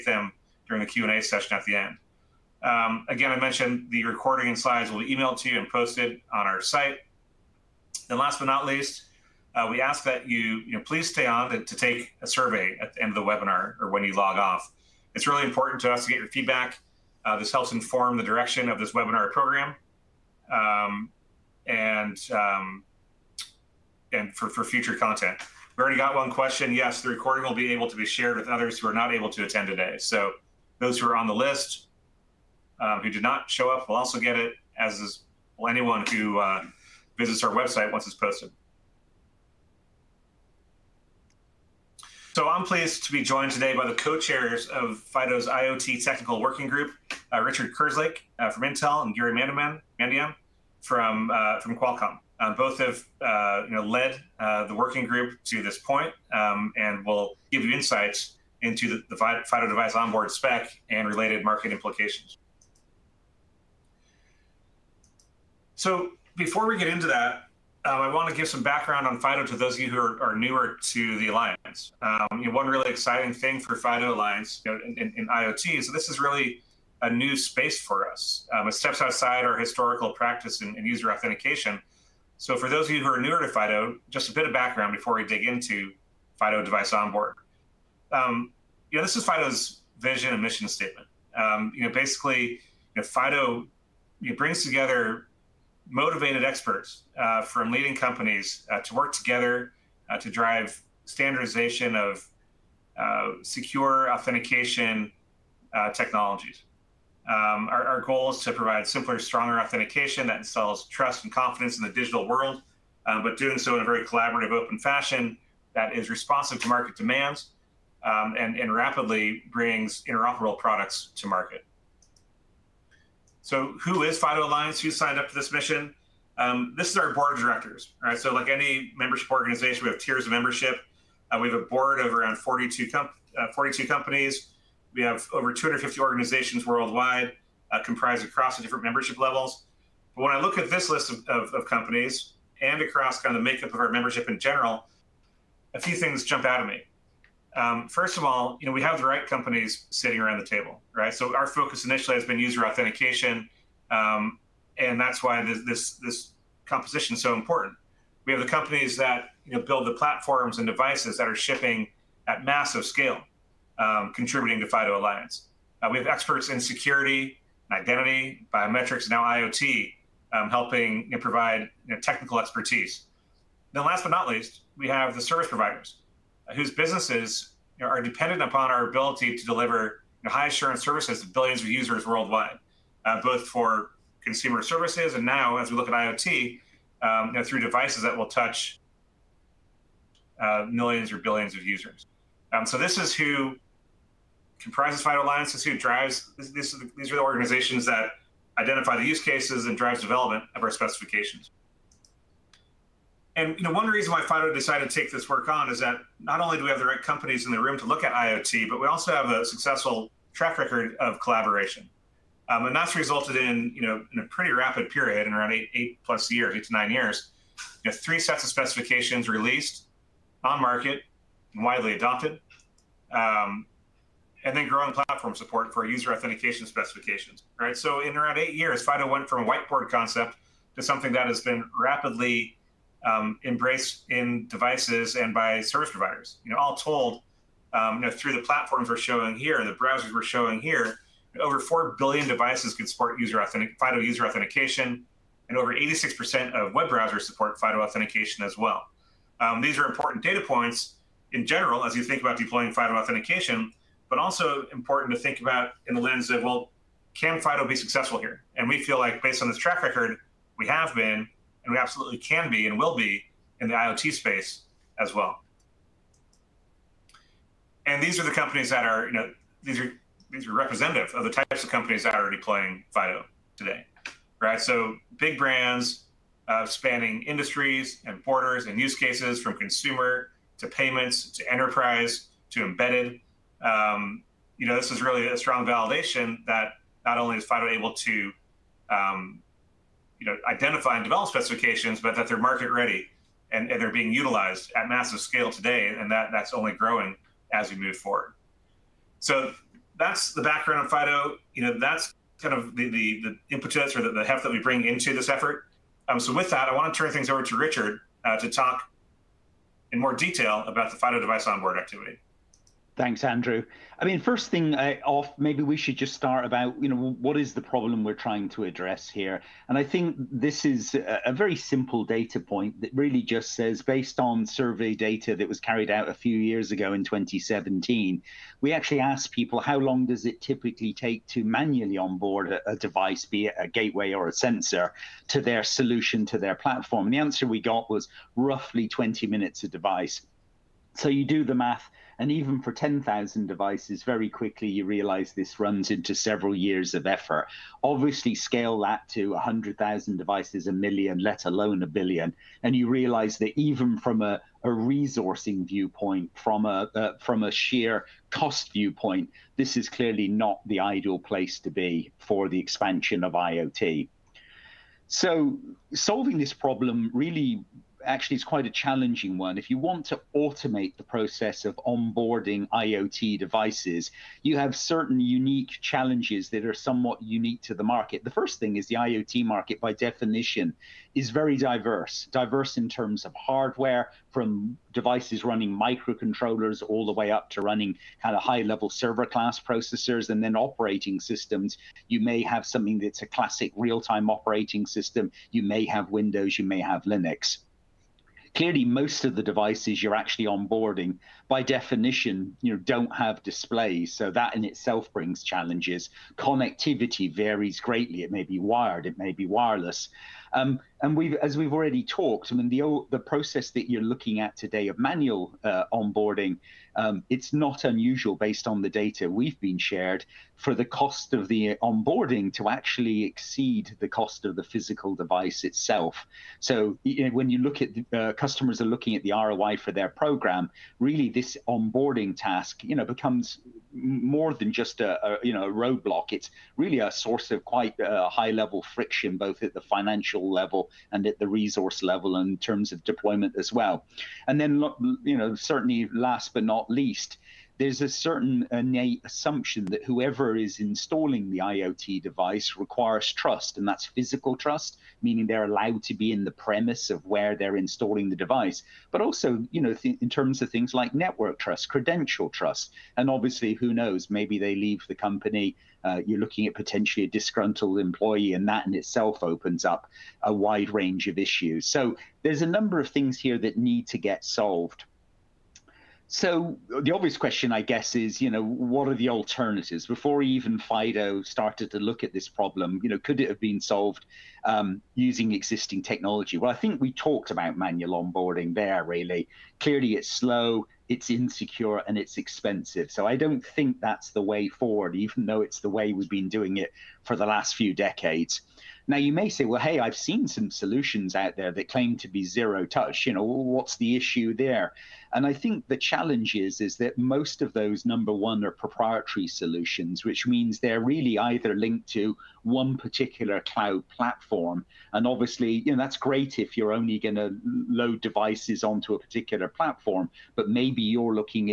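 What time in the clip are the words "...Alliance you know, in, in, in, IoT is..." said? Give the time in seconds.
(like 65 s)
74 s.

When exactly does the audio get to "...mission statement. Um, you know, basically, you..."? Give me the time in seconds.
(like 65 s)
90 s.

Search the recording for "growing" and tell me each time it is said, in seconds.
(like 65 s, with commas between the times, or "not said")
224 s, 296 s.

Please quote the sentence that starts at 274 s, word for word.
So big brands uh, spanning industries and borders and use cases from consumer to payments to enterprise to embedded.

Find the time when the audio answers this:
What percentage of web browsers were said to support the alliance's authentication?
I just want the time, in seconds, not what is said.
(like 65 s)
245 s.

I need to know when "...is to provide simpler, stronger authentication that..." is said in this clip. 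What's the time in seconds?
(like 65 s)
108 s.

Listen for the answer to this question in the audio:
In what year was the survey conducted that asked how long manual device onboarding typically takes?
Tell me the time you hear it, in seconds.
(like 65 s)
327 s.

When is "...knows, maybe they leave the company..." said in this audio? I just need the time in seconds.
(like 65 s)
463 s.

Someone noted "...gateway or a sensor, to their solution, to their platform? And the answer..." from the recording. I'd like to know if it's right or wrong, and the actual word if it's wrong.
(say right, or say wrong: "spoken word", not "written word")
right.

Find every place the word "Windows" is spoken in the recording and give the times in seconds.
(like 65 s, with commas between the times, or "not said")
396 s.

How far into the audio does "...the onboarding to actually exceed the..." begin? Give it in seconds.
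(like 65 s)
421 s.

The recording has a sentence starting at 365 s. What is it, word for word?
So solving this problem really actually it's quite a challenging one.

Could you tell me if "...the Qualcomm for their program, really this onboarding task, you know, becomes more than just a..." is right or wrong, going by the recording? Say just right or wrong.
wrong.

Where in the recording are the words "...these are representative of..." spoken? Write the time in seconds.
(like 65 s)
270 s.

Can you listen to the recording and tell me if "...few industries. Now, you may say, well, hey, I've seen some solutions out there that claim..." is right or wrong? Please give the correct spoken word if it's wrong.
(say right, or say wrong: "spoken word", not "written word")
wrong: "decades", not "industries".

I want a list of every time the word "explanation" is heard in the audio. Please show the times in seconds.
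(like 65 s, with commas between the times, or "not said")
not said.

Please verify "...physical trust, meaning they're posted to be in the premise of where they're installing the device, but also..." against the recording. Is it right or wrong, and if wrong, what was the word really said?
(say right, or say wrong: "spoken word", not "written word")
wrong: "allowed", not "posted".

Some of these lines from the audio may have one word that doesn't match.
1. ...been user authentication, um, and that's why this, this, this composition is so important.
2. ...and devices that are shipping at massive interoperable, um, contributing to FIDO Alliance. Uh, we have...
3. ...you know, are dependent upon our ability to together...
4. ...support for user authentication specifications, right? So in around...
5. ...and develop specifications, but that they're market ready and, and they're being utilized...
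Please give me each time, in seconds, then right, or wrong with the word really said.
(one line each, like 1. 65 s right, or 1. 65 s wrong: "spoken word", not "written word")
1. 152 s right
2. 160 s wrong: "scale", not "interoperable"
3. 177 s wrong: "deliver", not "together"
4. 225 s right
5. 290 s right.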